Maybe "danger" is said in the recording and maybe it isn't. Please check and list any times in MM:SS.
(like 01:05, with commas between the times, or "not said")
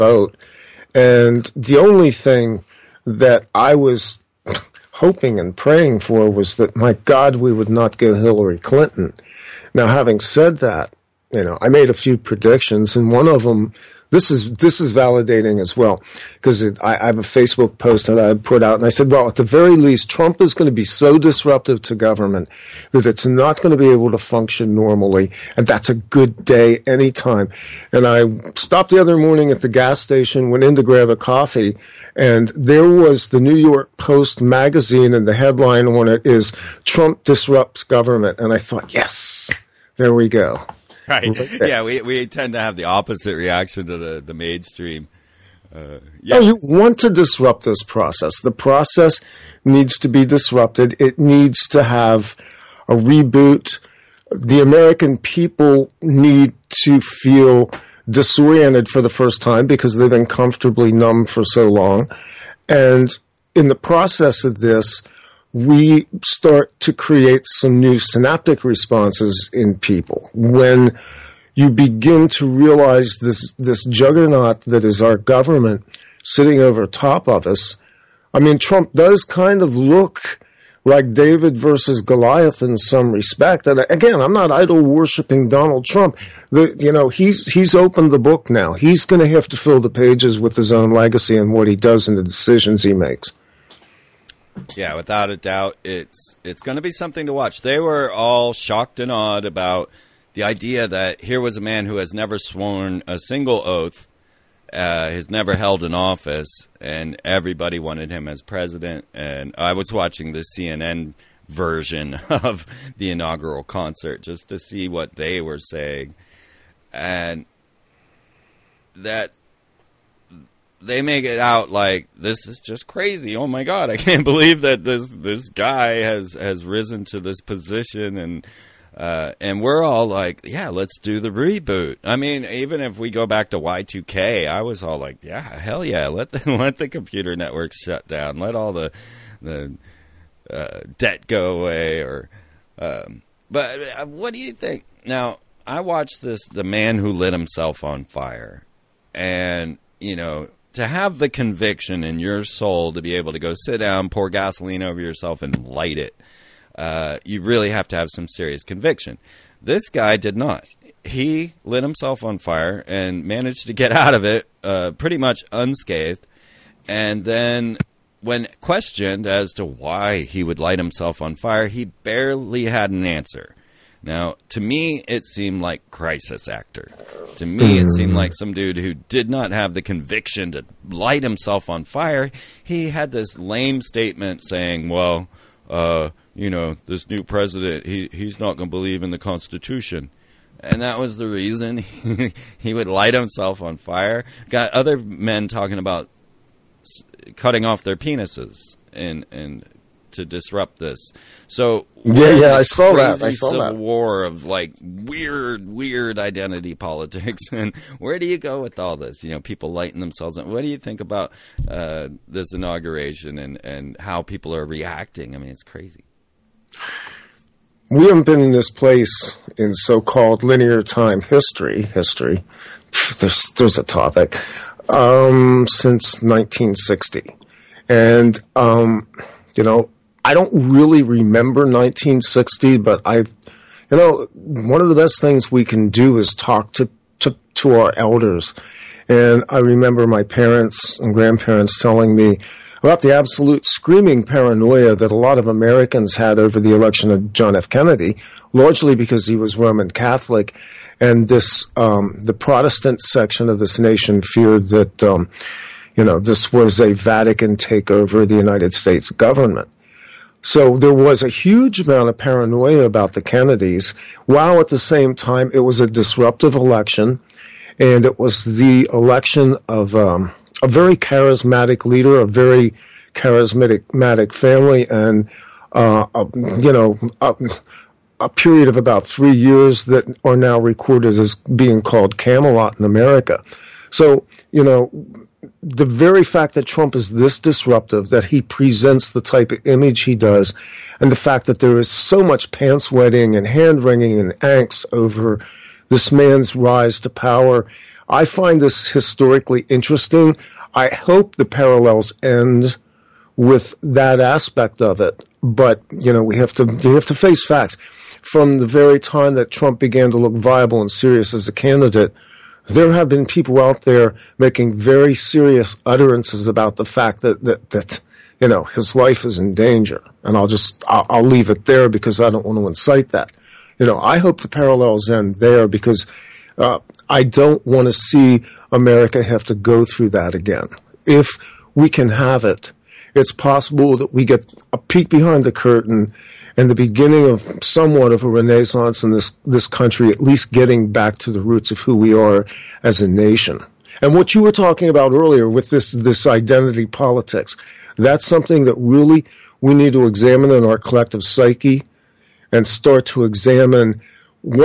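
05:19.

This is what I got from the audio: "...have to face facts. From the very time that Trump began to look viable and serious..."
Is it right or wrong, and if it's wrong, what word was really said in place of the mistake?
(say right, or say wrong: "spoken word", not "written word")
right.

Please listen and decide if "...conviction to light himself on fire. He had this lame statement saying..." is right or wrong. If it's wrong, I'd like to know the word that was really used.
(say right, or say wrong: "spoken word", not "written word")
right.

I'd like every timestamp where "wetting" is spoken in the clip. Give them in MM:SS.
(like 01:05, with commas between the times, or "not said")
04:52.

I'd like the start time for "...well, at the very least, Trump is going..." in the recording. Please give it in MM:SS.
00:19.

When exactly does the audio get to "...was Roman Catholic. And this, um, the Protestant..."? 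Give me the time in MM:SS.
04:09.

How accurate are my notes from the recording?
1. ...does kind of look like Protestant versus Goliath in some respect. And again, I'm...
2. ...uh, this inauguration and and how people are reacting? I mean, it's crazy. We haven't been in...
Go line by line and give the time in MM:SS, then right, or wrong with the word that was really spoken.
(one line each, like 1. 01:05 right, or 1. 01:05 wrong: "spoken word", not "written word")
1. 01:18 wrong: "David", not "Protestant"
2. 03:31 right.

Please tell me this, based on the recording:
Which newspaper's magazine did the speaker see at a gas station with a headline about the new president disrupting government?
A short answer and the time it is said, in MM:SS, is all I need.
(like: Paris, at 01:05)
New York Post, at 00:33.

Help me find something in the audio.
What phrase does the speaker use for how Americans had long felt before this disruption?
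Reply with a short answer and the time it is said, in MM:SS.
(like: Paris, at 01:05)
comfortably numb, at 01:00.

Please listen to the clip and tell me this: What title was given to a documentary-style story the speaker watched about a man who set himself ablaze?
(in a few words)
The Man Who Lit Himself on Fire.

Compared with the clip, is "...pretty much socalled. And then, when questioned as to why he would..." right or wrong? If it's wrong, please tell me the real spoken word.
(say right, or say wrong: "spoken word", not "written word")
wrong: "unscathed", not "socalled".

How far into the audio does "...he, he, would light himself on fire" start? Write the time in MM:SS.
03:11.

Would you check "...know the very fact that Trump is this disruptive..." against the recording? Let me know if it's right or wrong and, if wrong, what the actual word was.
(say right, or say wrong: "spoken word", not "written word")
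right.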